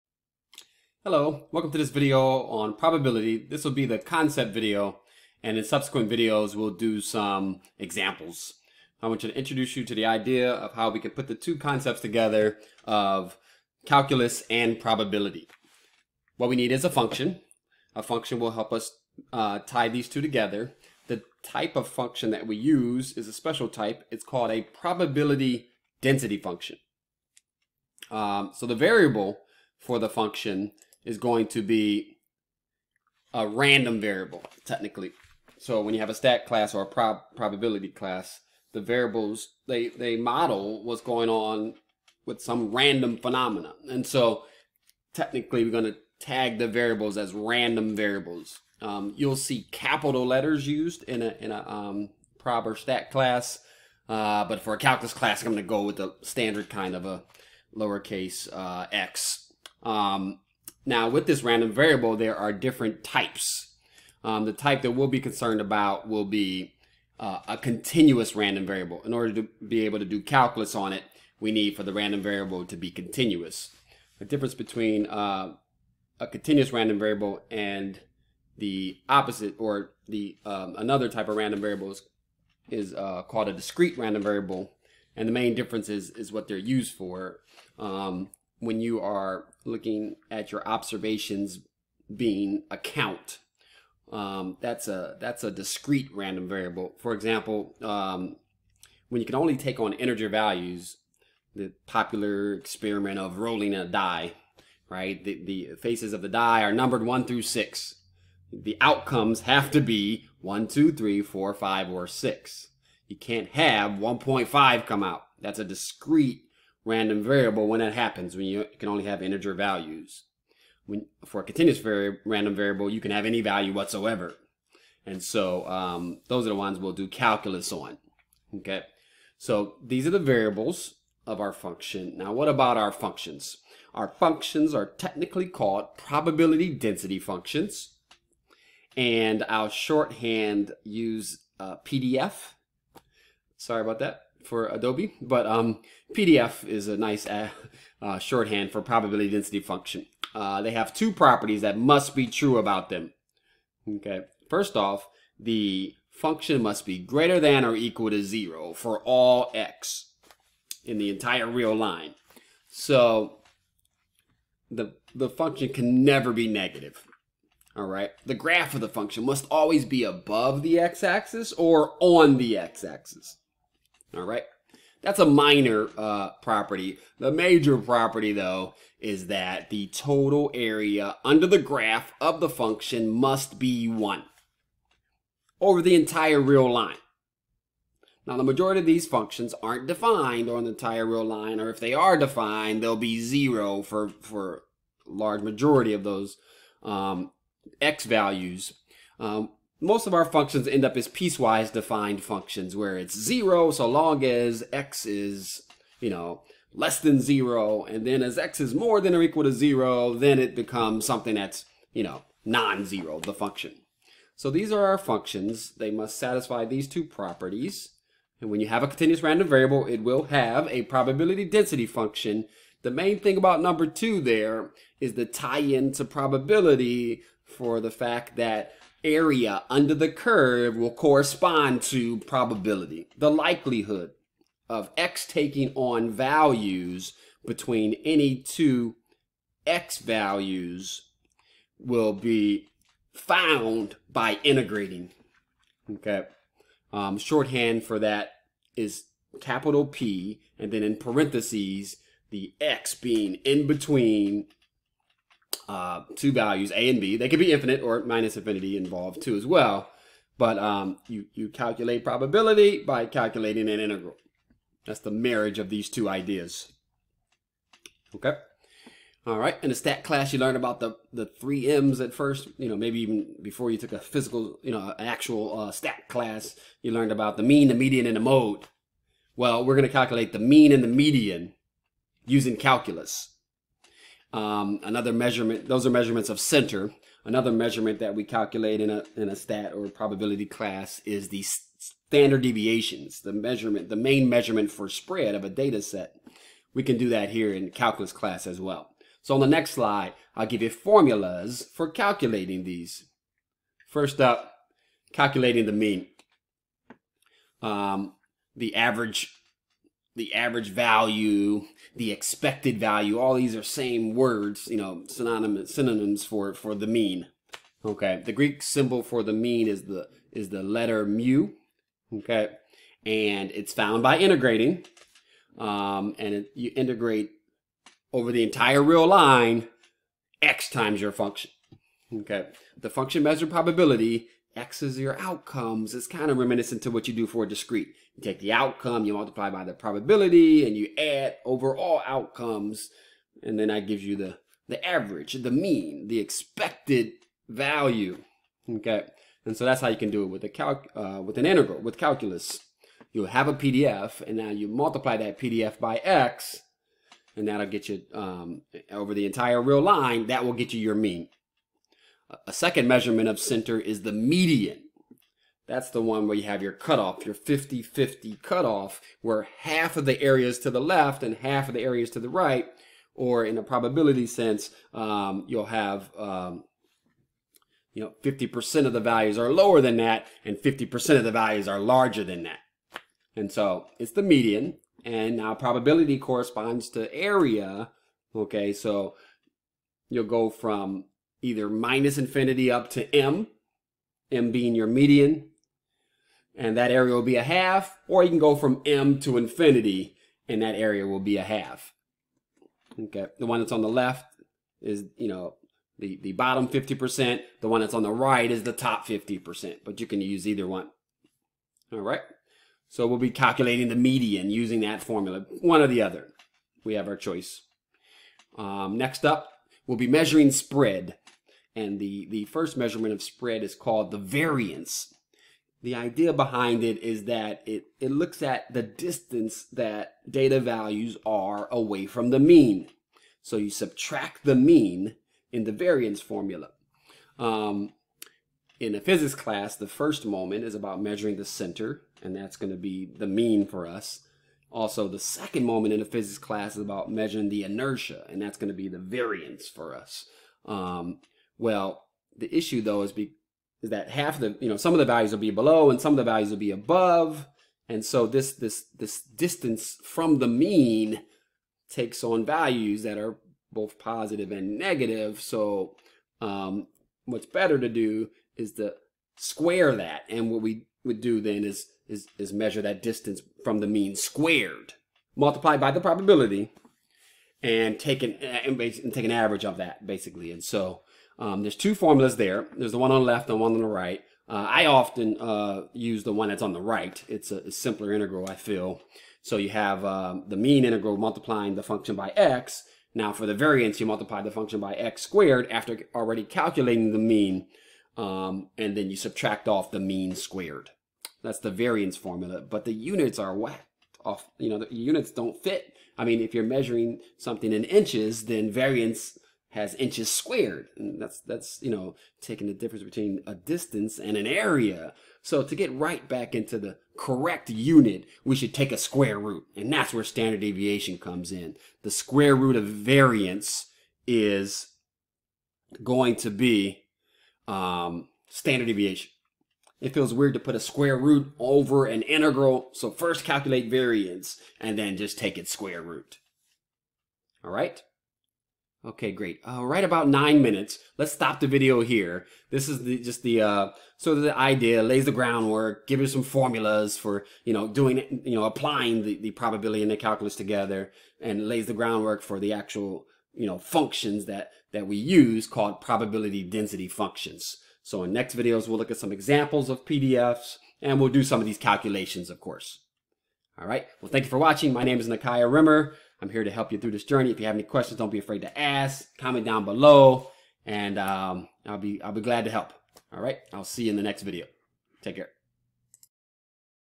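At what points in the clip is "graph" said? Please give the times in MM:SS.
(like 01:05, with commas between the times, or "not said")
02:48, 03:01.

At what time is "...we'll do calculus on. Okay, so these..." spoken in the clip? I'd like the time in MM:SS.
02:06.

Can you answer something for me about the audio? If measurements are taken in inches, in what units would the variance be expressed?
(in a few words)
inches squared.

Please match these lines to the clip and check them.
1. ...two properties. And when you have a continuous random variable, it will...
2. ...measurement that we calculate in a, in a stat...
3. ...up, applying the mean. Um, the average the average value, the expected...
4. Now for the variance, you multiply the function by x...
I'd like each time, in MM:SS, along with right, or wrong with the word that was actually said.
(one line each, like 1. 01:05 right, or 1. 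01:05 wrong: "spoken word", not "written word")
1. 03:36 right
2. 04:47 right
3. 05:04 wrong: "calculating", not "applying"
4. 08:13 right.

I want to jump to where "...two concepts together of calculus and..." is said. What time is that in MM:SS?
00:11.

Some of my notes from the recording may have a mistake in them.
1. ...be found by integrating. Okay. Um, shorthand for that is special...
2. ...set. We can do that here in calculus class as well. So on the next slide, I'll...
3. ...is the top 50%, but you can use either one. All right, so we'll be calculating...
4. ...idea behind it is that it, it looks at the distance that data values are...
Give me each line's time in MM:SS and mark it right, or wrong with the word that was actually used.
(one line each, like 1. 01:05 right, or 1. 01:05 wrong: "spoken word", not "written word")
1. 04:02 wrong: "capital", not "special"
2. 04:55 right
3. 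06:48 right
4. 07:05 right.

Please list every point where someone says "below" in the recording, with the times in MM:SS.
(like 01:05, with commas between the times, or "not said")
07:35, 09:29.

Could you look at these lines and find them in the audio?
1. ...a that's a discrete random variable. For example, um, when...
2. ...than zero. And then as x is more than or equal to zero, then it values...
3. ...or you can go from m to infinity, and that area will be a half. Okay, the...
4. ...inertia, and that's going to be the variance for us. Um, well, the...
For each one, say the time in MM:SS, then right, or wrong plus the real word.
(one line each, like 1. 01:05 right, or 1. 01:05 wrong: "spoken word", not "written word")
1. 01:34 right
2. 03:26 wrong: "becomes", not "values"
3. 06:38 right
4. 07:27 right.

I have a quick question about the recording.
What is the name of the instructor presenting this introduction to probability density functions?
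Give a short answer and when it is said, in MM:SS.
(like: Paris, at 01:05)
Nakia Rimmer, at 09:25.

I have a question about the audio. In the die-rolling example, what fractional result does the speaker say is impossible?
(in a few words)
1.5.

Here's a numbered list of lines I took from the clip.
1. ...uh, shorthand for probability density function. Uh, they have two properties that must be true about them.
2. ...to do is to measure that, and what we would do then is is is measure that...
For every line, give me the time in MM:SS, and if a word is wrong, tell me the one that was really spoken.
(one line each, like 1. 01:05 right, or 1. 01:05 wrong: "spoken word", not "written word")
1. 02:28 right
2. 07:47 wrong: "square", not "measure".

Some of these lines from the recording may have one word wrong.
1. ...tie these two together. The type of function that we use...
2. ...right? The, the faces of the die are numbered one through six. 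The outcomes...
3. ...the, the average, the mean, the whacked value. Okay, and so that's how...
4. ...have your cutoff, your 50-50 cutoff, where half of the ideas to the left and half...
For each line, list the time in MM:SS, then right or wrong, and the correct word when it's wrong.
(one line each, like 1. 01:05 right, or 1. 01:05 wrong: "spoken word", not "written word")
1. 00:19 right
2. 01:44 right
3. 05:44 wrong: "expected", not "whacked"
4. 06:06 wrong: "areas", not "ideas".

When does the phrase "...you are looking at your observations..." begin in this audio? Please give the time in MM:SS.
01:28.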